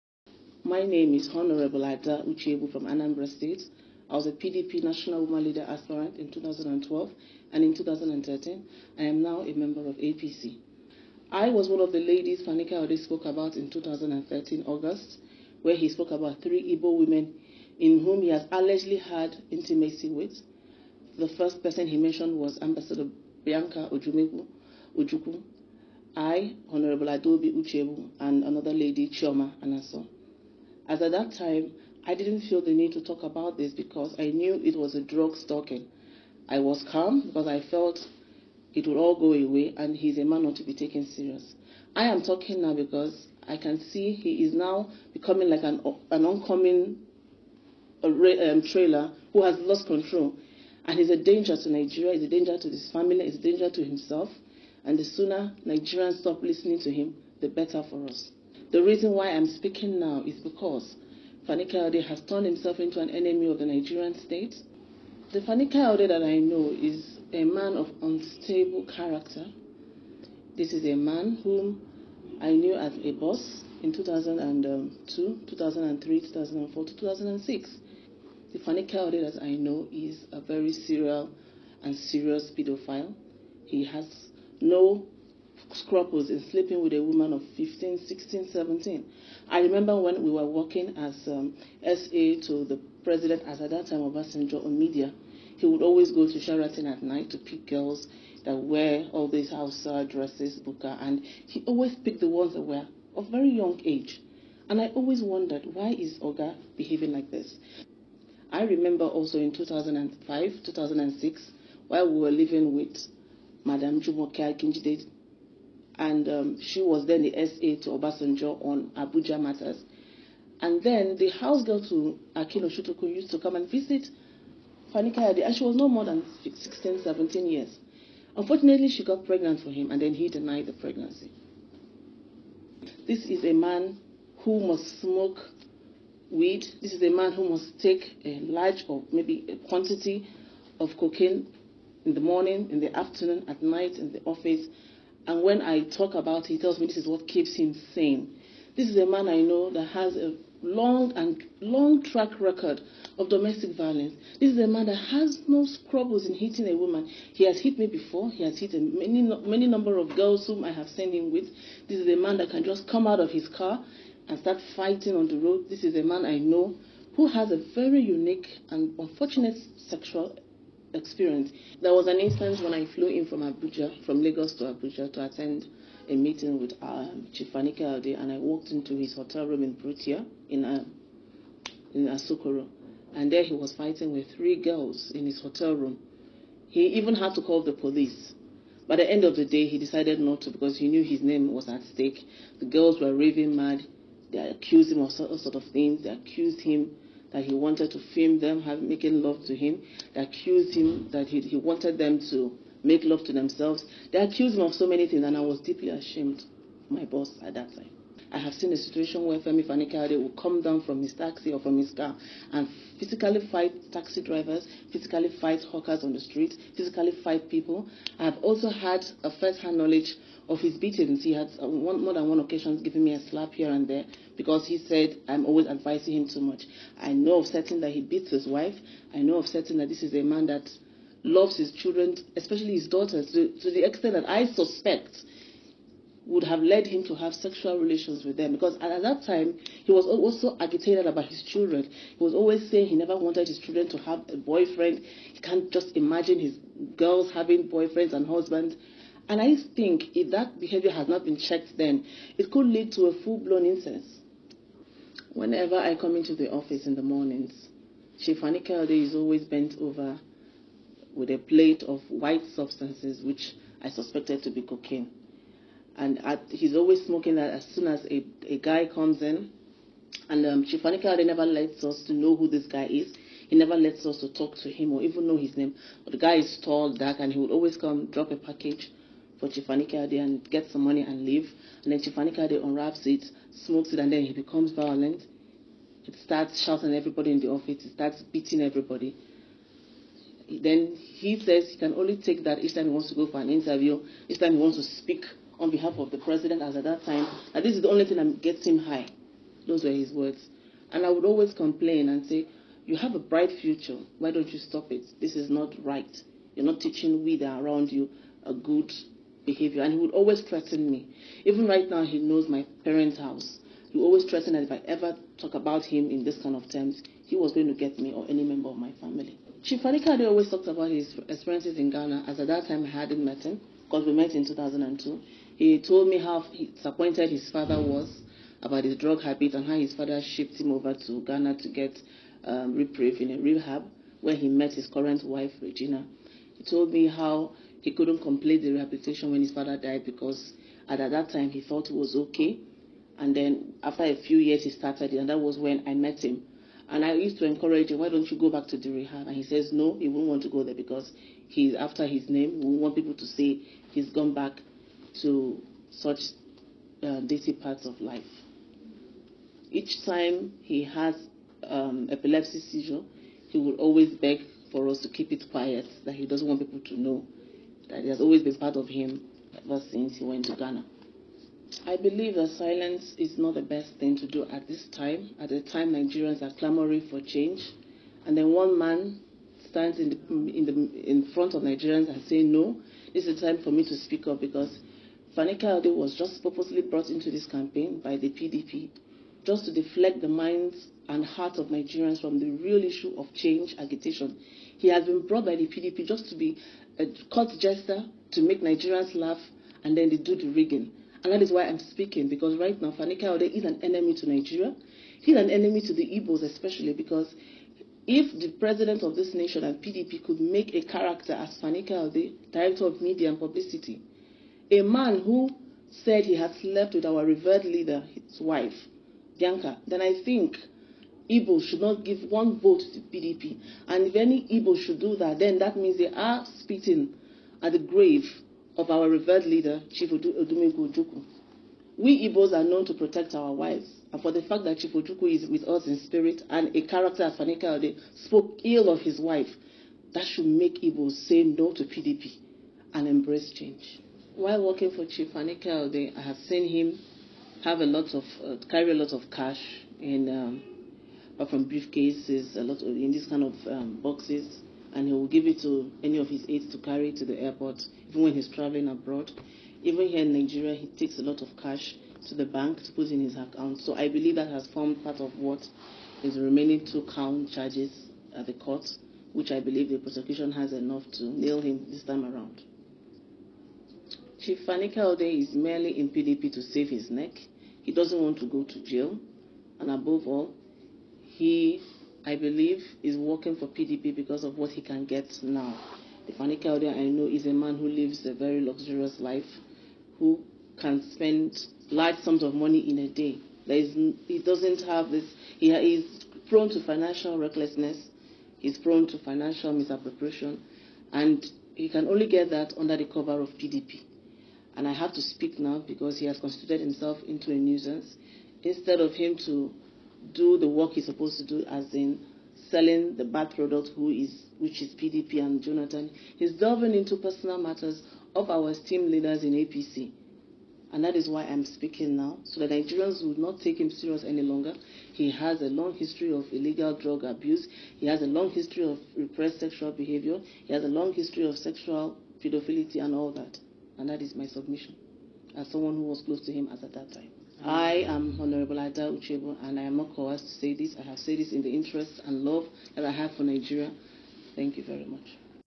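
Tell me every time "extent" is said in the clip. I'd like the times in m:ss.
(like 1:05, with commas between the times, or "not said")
3:53.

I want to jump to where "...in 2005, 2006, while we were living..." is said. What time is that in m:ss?
1:49.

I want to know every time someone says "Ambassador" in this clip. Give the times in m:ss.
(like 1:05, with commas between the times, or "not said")
0:22.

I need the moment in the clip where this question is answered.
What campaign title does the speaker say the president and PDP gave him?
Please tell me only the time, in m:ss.
6:52.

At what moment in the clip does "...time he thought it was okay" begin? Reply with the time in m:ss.
5:41.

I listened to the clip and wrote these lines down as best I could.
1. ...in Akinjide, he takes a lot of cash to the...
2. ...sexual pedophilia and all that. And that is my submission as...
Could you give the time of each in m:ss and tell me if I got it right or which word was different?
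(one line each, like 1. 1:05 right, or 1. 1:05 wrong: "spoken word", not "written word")
1. 7:40 wrong: "Nigeria", not "Akinjide"
2. 8:51 right.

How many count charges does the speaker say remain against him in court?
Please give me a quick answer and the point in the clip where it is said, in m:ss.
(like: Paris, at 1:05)
2, at 7:46.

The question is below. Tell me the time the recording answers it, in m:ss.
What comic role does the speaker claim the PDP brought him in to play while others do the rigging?
6:37.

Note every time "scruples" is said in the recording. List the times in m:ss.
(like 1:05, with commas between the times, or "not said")
1:25, 2:35.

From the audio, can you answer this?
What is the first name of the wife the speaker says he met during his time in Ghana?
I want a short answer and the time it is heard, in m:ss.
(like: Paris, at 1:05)
Regina, at 5:35.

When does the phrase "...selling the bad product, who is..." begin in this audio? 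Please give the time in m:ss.
8:32.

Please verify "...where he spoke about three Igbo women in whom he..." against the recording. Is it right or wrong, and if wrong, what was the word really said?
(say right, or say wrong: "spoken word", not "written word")
right.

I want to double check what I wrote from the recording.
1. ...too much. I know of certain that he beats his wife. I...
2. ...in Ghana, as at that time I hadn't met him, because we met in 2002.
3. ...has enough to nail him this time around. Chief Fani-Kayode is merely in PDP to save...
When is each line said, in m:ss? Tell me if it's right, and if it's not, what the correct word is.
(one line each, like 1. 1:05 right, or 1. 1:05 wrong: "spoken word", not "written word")
1. 3:46 right
2. 5:21 right
3. 7:50 right.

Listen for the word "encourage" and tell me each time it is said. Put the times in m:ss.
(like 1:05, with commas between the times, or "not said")
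5:47.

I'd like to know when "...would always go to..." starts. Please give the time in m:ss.
1:35.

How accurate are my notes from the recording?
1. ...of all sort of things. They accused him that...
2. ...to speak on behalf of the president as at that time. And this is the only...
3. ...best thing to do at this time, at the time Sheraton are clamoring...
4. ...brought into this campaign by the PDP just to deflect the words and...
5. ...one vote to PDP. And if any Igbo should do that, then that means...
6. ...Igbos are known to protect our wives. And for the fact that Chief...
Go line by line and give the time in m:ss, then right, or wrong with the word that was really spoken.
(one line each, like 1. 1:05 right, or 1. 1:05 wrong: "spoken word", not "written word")
1. 3:15 right
2. 4:54 right
3. 6:13 wrong: "Nigerians", not "Sheraton"
4. 6:26 wrong: "minds", not "words"
5. 7:02 right
6. 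7:12 right.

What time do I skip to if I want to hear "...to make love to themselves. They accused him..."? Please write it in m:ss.
3:22.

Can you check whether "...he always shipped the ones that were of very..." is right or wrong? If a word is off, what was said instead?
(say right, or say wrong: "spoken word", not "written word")
wrong: "picked", not "shipped".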